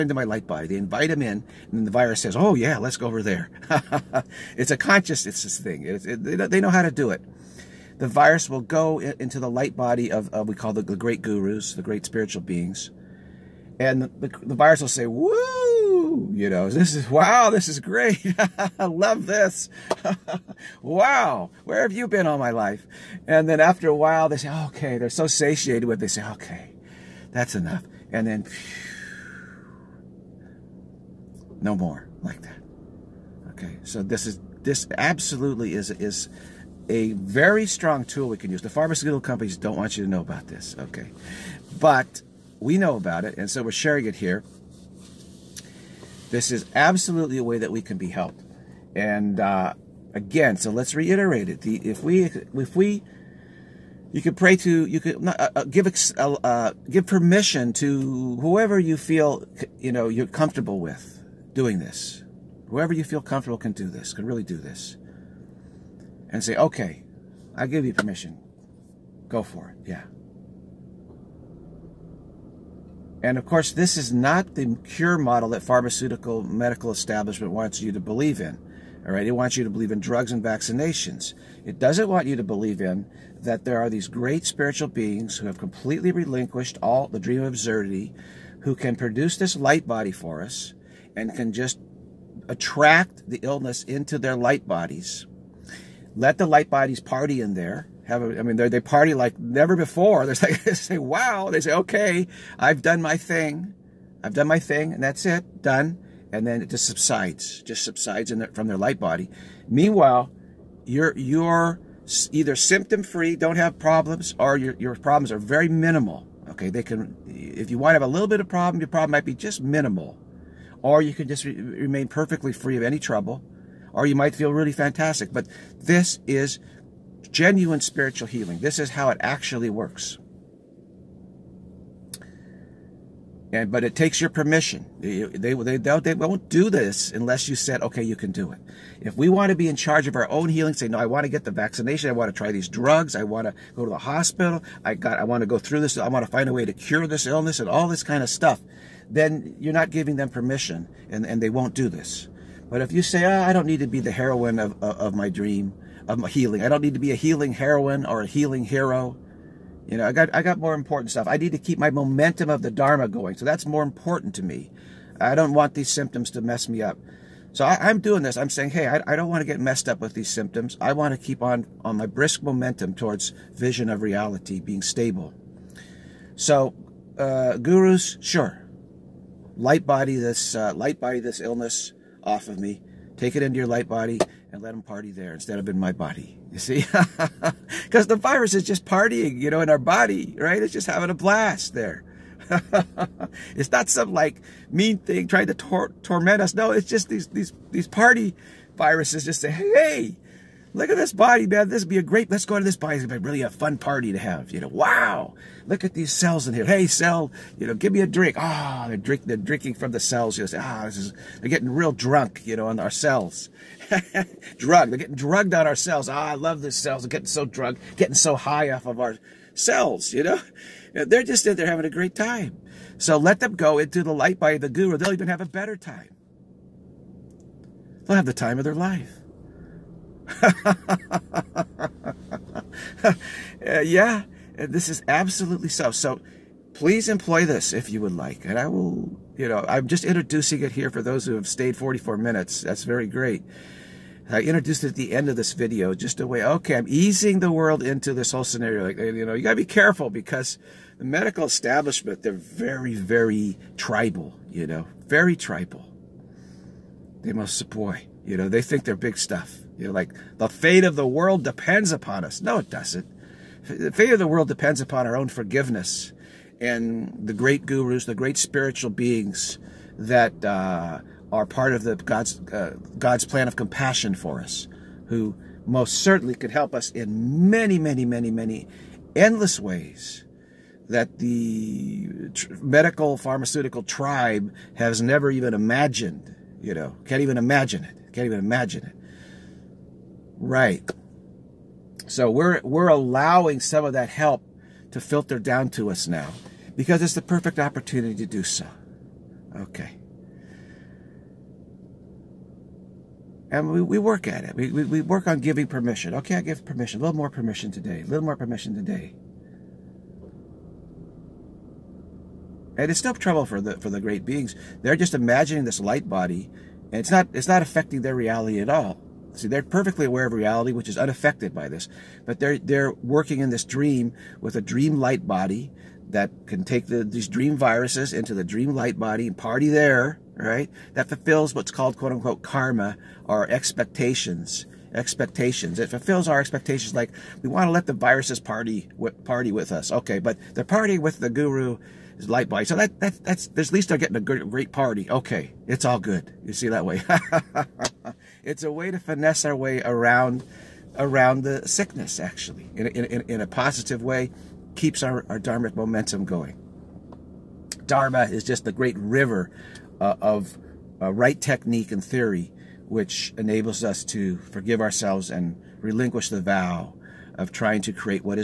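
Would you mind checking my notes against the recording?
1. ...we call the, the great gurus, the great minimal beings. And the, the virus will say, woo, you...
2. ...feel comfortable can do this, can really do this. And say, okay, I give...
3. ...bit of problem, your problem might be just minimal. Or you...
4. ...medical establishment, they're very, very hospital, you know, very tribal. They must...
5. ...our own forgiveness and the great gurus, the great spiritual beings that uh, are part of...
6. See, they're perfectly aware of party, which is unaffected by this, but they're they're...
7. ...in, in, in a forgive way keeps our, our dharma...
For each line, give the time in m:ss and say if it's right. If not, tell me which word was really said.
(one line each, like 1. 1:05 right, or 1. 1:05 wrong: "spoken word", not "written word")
1. 0:10 wrong: "spiritual", not "minimal"
2. 1:03 right
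3. 1:58 right
4. 4:11 wrong: "tribal", not "hospital"
5. 4:25 right
6. 5:19 wrong: "reality", not "party"
7. 5:52 wrong: "positive", not "forgive".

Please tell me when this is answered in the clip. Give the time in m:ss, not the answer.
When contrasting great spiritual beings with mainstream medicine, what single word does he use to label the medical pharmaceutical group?
4:43.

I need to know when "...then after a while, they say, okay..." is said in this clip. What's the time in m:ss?
0:23.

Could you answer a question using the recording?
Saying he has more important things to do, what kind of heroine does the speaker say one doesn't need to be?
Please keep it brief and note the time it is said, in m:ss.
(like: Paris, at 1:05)
healing heroine, at 2:37.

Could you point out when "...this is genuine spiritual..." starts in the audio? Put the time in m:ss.
2:05.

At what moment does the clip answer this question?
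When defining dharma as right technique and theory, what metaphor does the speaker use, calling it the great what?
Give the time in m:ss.
5:58.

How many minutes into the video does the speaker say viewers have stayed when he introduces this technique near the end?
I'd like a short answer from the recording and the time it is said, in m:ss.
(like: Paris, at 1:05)
44, at 4:01.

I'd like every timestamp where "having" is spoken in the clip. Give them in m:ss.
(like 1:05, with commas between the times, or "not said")
3:10, 3:41.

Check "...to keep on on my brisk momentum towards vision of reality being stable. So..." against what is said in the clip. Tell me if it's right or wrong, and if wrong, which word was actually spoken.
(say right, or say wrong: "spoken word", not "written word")
right.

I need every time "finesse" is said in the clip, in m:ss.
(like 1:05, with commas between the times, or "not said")
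5:48.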